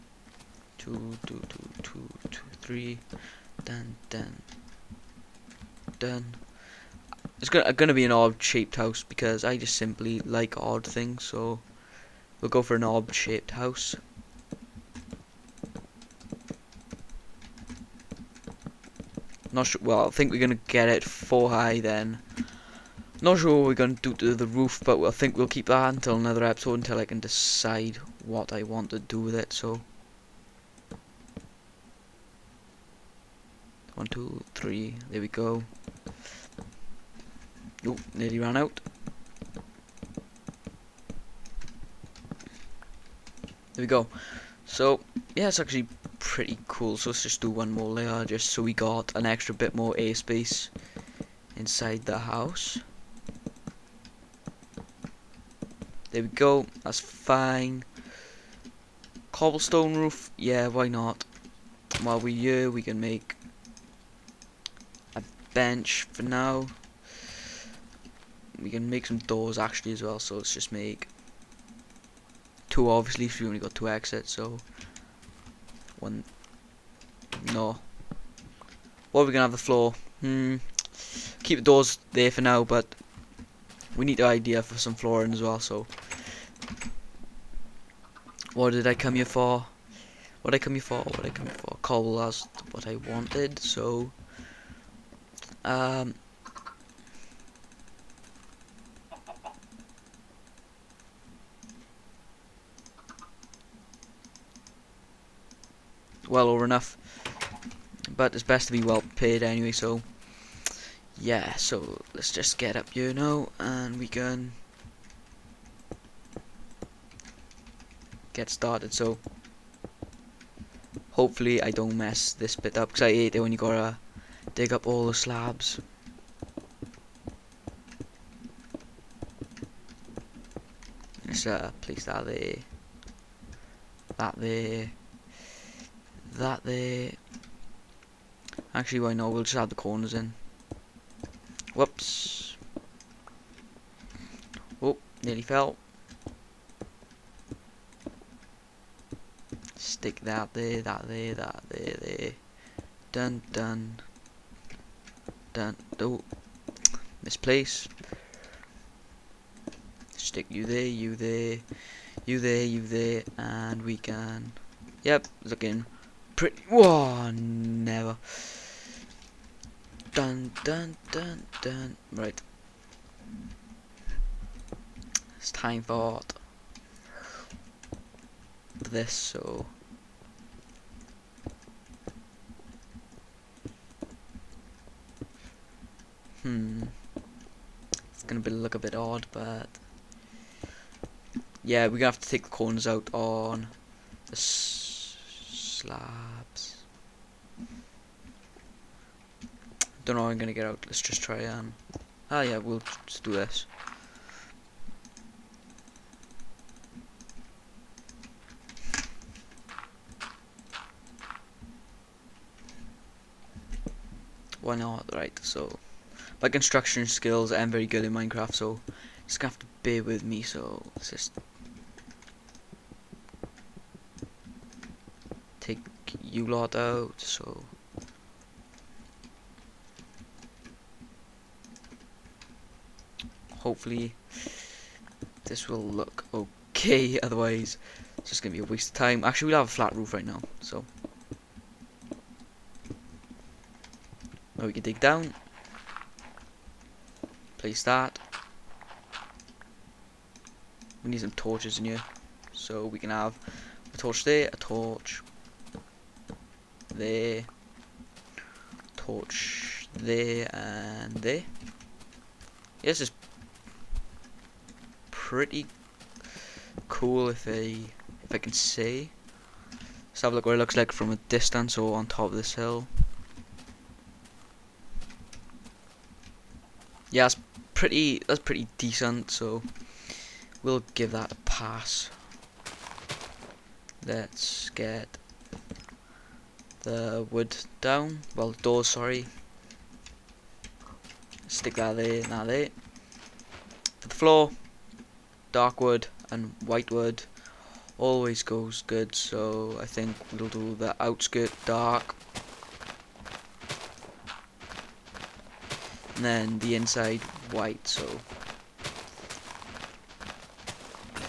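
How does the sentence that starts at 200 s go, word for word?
Don't know how I'm gonna get out.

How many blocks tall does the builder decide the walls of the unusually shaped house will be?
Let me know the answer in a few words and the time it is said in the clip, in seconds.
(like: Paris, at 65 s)
4, at 21 s.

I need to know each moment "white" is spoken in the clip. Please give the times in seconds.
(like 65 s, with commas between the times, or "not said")
296 s, 307 s.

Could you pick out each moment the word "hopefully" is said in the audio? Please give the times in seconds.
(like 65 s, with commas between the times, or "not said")
121 s, 233 s.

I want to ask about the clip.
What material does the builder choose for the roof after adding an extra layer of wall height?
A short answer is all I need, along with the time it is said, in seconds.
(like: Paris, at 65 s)
Cobblestone, at 59 s.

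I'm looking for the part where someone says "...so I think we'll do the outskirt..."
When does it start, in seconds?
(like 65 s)
299 s.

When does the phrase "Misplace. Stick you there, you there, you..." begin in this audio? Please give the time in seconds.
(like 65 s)
157 s.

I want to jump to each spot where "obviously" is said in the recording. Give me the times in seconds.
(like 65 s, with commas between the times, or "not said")
72 s.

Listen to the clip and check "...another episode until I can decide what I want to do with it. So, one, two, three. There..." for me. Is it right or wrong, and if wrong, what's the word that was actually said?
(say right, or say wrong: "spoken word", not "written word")
right.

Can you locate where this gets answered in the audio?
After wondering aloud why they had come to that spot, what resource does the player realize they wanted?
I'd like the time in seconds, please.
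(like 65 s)
91 s.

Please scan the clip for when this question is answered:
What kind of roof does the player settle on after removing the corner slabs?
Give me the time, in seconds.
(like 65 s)
239 s.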